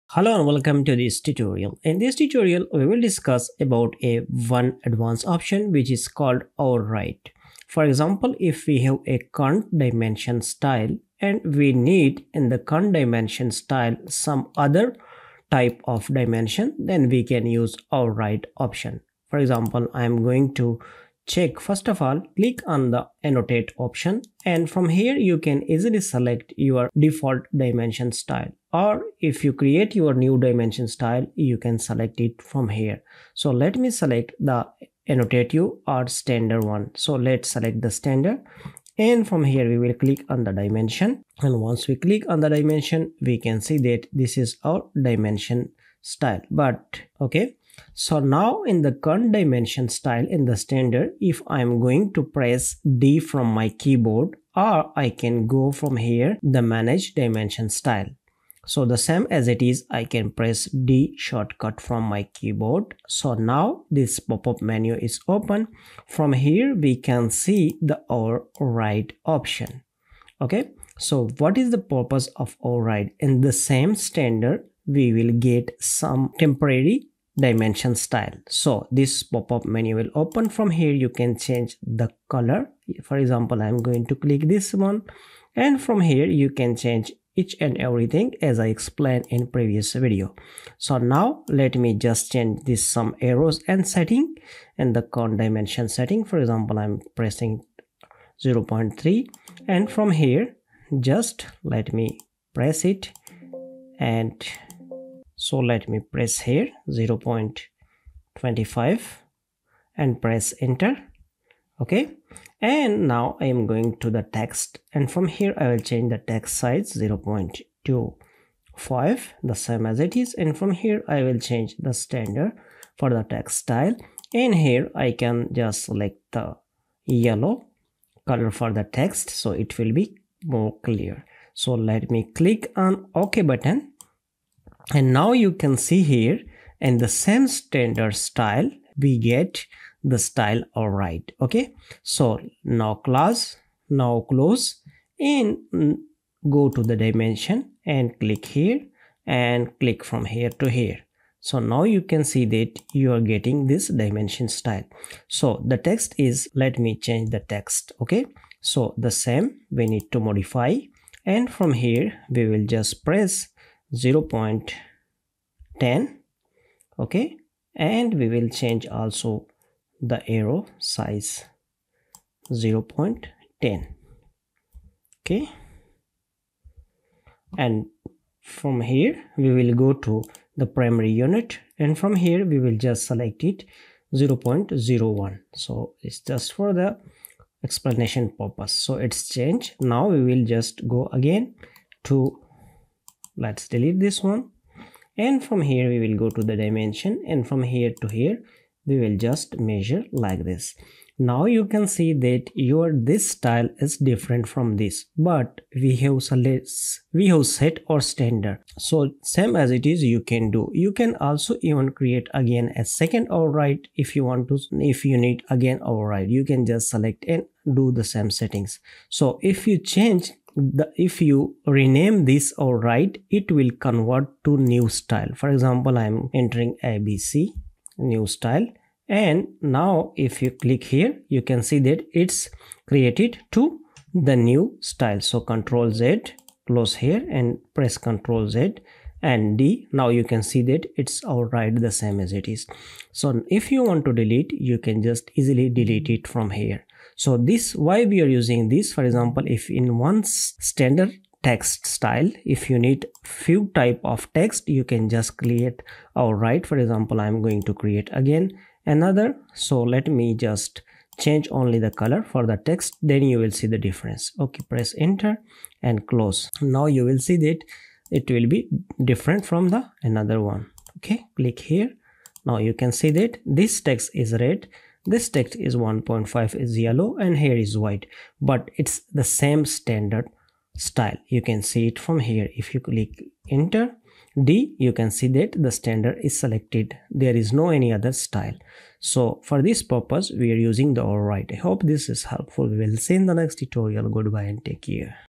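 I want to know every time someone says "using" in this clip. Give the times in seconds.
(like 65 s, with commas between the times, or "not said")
248 s, 290 s.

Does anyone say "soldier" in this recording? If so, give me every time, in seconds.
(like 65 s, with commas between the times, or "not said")
not said.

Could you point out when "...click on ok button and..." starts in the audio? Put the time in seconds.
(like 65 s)
132 s.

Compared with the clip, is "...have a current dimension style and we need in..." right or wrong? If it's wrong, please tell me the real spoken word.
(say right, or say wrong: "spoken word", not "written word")
right.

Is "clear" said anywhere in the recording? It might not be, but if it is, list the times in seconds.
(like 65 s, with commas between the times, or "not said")
130 s.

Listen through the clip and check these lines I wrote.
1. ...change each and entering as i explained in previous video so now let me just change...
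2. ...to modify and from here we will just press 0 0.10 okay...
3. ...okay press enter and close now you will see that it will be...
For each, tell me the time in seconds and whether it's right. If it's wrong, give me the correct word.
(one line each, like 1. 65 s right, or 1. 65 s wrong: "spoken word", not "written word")
1. 86 s wrong: "everything", not "entering"
2. 160 s right
3. 264 s right.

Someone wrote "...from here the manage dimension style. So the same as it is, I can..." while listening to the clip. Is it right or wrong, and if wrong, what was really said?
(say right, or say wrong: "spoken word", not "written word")
right.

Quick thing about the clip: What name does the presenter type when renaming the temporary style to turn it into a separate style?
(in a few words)
abc.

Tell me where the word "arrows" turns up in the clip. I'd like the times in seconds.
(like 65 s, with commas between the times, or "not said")
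93 s, 170 s.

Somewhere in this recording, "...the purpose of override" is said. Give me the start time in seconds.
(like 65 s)
71 s.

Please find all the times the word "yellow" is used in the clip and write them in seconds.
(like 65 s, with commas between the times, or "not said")
127 s, 276 s.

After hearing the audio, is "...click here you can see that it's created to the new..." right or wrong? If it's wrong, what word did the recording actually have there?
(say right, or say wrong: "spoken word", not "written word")
right.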